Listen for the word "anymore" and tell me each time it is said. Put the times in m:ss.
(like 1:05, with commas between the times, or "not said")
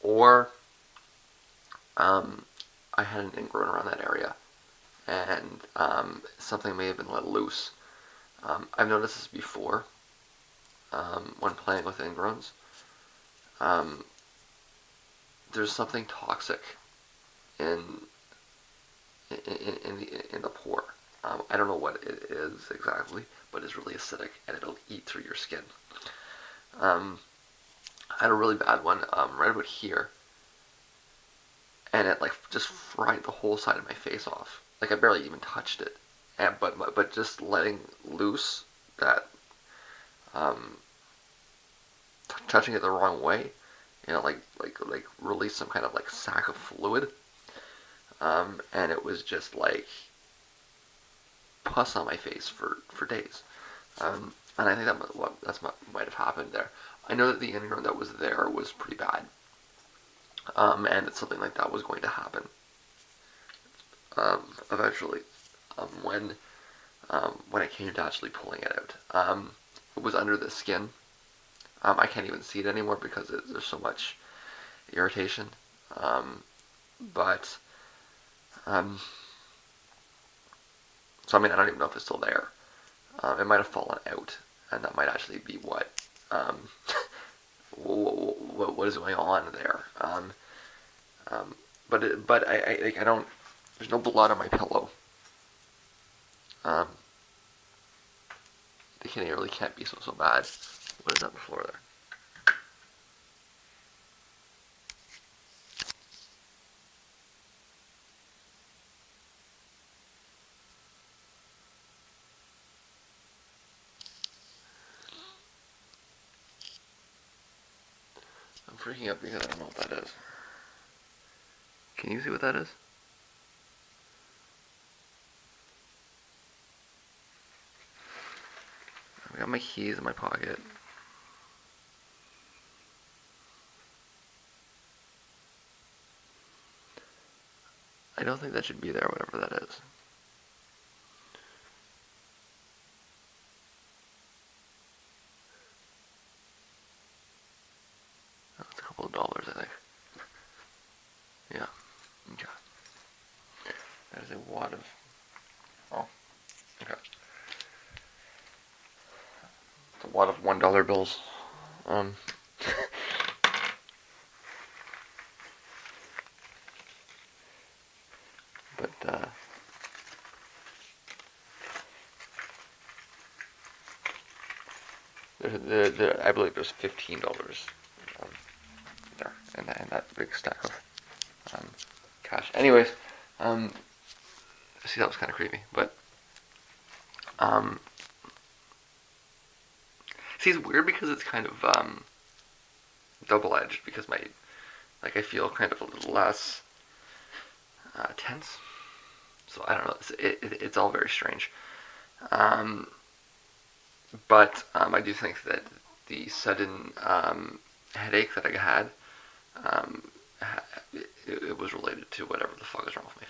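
1:12.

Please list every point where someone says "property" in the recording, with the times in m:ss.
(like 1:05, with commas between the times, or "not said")
not said.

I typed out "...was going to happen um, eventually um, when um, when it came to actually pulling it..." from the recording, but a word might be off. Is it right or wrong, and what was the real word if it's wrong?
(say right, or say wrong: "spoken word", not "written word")
right.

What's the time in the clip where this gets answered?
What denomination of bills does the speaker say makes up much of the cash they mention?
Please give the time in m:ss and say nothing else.
2:40.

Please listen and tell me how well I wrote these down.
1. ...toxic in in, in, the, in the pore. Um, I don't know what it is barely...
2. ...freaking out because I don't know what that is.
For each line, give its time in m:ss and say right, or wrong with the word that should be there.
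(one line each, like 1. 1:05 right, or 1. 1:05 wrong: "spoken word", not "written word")
1. 0:16 wrong: "exactly", not "barely"
2. 1:58 right.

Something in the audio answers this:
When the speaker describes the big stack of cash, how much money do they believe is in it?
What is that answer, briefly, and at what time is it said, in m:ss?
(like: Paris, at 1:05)
$15, at 2:56.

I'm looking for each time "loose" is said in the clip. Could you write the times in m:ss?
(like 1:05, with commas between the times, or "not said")
0:07, 0:38.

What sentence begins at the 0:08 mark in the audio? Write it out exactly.
Um, I've noticed this before um, when playing with ingrowns.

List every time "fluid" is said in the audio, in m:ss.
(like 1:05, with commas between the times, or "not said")
0:46.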